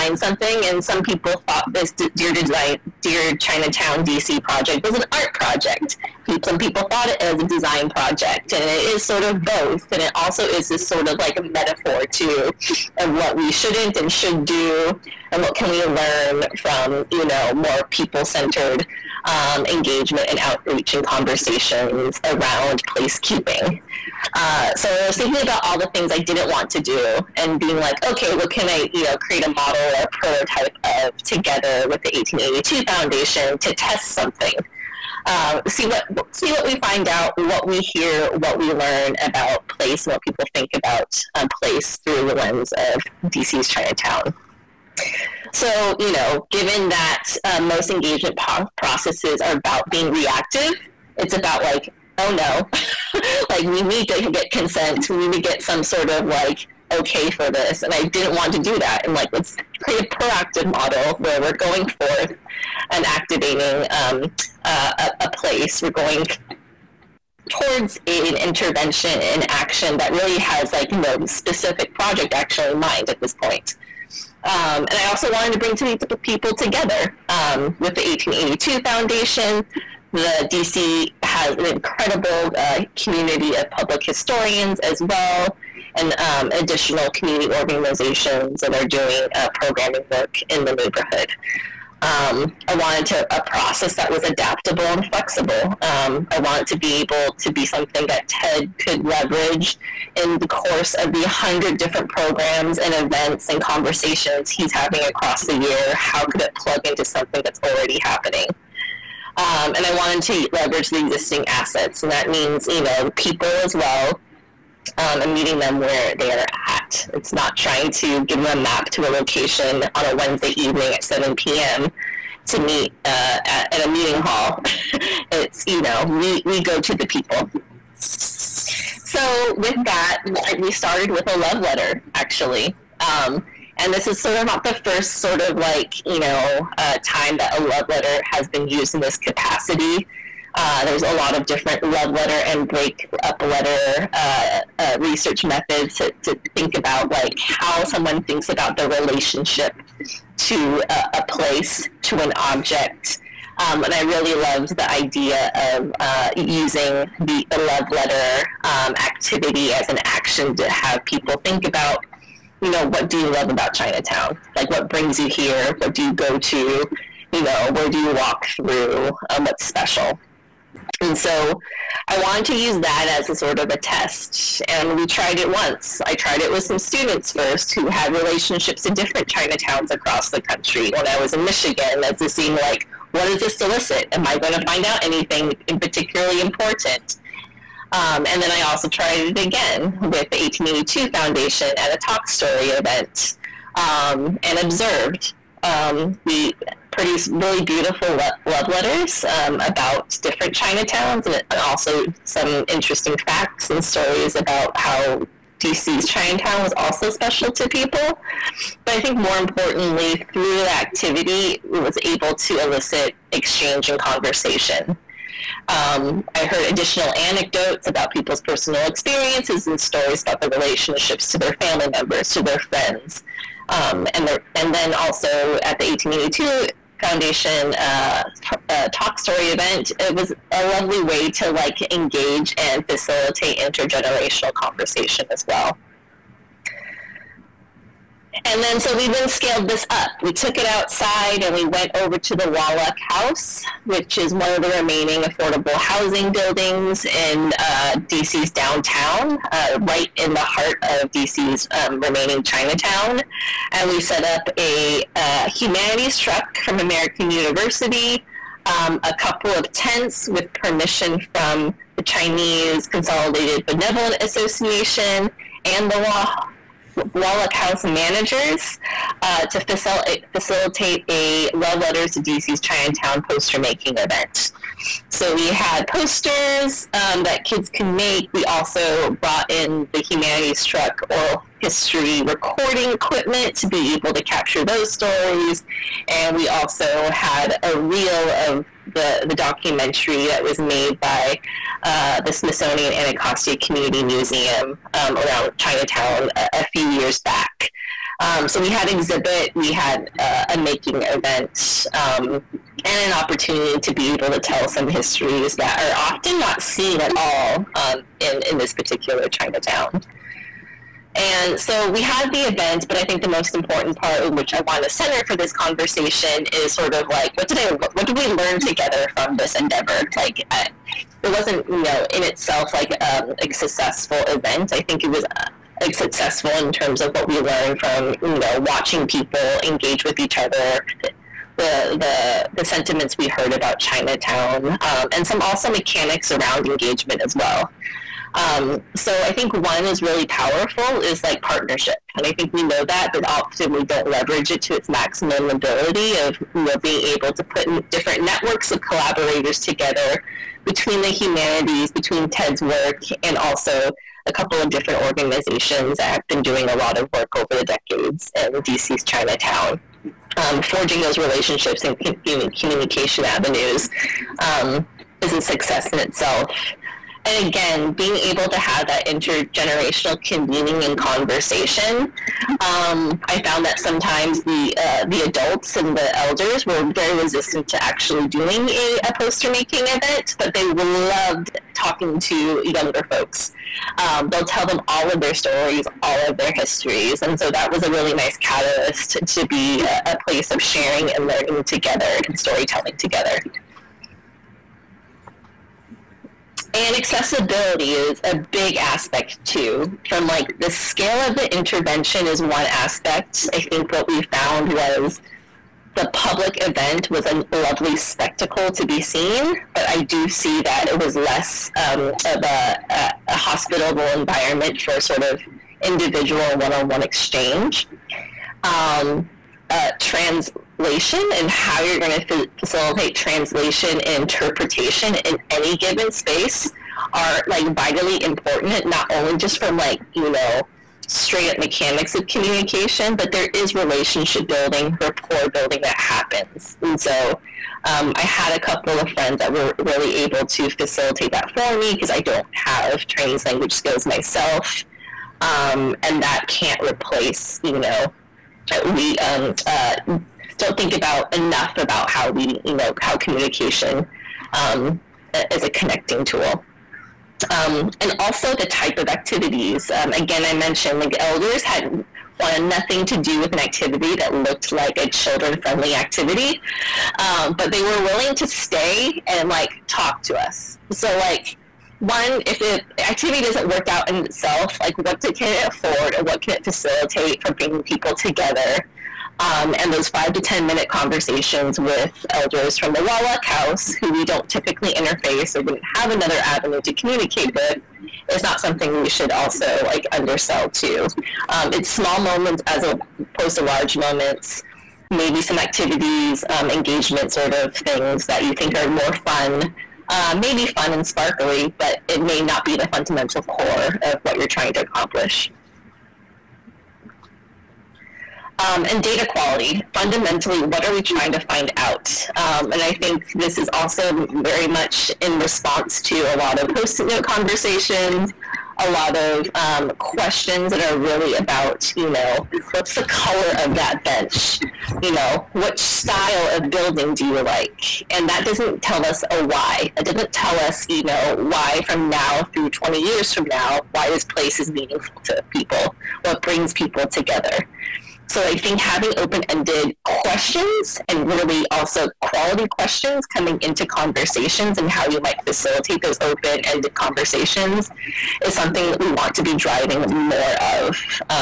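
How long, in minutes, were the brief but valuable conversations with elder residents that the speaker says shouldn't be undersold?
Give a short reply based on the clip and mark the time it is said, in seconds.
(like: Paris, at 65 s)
5 to 10 minutes, at 480 s.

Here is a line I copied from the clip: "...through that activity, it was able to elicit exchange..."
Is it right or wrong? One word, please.
right.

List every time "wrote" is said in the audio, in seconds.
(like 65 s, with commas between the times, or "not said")
not said.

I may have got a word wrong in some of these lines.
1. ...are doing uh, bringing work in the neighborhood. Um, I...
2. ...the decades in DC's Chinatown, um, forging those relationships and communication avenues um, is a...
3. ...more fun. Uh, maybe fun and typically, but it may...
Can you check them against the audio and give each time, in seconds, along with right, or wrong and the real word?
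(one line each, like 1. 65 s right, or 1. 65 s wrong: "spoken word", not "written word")
1. 88 s wrong: "programming", not "bringing"
2. 357 s right
3. 498 s wrong: "sparkly", not "typically".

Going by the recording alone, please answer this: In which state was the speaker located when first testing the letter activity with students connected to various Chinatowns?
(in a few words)
Michigan.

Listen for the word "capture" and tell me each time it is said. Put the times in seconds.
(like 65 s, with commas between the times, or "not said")
284 s.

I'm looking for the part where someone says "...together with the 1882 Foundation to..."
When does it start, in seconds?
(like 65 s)
31 s.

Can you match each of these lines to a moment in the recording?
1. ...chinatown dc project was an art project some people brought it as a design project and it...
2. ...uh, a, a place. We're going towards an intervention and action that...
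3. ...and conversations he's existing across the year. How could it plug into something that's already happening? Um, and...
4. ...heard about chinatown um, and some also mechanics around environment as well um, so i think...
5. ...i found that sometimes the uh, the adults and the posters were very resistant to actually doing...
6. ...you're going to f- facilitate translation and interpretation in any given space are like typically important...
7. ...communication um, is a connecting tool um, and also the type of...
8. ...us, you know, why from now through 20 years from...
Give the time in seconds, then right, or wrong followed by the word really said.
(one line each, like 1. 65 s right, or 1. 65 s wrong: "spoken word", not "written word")
1. 3 s wrong: "thought", not "brought"
2. 64 s right
3. 103 s wrong: "having", not "existing"
4. 333 s wrong: "engagement", not "environment"
5. 373 s wrong: "elders", not "posters"
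6. 421 s wrong: "vitally", not "typically"
7. 453 s right
8. 530 s right.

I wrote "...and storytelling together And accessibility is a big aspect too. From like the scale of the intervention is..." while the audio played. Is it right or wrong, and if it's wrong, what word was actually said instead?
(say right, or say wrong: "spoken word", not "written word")
right.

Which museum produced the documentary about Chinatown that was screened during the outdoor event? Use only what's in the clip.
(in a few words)
Smithsonian Anacostia Community Museum.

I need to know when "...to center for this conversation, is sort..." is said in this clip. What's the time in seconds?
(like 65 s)
314 s.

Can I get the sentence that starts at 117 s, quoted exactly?
It's not trying to give them a map to a location on a Wednesday evening at 7 p.m.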